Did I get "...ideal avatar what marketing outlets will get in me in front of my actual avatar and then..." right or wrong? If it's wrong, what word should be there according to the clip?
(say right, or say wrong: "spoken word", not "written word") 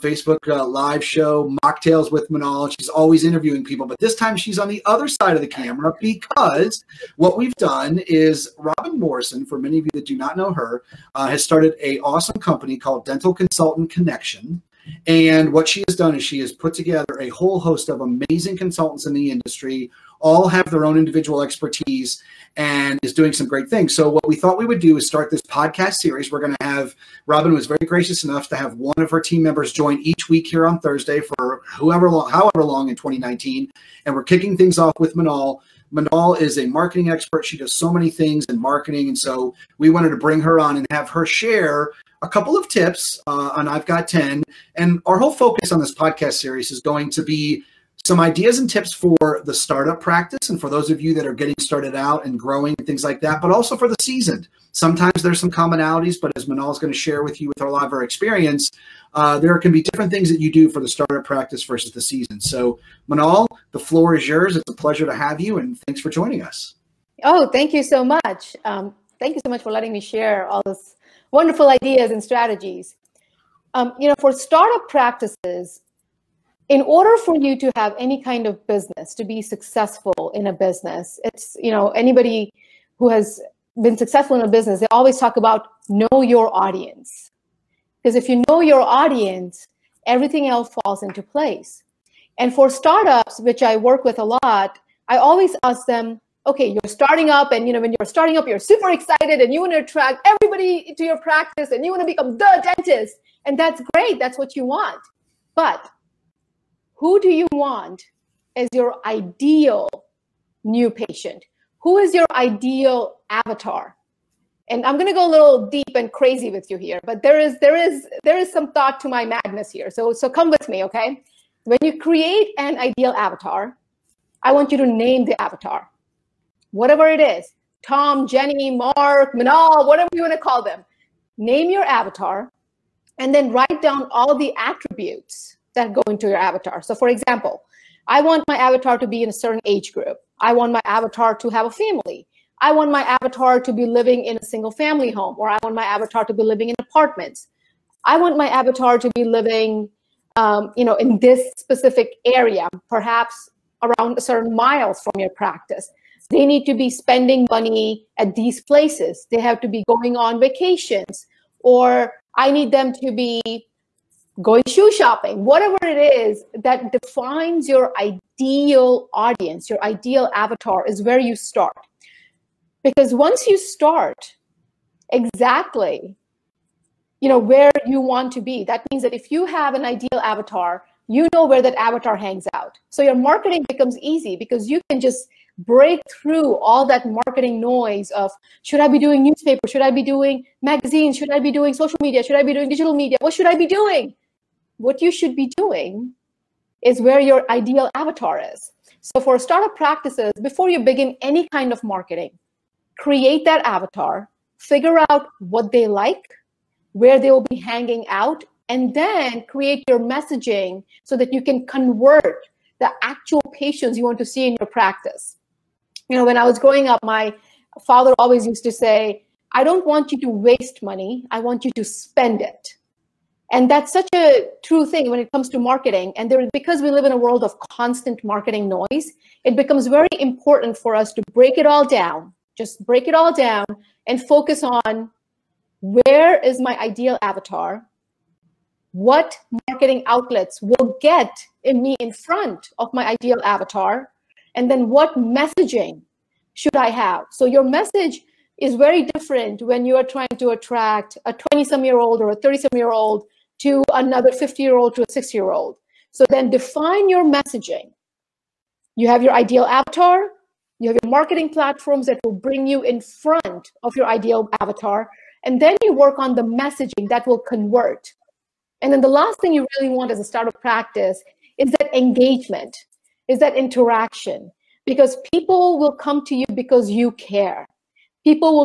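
wrong: "ideal", not "actual".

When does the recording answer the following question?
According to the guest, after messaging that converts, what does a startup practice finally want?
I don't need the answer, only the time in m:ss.
4:31.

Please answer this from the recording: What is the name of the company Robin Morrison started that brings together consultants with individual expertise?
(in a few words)
Dental Consultant Connection.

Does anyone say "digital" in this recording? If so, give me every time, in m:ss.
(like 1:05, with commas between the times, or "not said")
3:12.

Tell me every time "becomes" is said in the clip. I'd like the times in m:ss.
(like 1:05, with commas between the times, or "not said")
1:42, 3:03, 3:49.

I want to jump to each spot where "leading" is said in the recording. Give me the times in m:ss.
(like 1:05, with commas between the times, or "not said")
not said.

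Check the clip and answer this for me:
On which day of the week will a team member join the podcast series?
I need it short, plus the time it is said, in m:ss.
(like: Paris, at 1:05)
Thursday, at 0:30.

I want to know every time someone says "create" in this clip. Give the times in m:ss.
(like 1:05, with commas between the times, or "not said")
2:01, 3:22, 3:29.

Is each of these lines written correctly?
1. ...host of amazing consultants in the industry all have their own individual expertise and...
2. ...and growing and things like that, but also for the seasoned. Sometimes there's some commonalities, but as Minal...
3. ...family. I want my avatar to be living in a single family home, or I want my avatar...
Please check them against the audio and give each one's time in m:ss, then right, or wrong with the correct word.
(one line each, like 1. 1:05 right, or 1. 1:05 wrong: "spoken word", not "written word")
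1. 0:17 right
2. 0:52 right
3. 2:21 right.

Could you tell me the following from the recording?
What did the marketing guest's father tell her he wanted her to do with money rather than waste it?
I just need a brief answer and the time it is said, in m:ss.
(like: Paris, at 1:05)
spend it, at 3:41.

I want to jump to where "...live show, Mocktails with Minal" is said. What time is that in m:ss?
0:00.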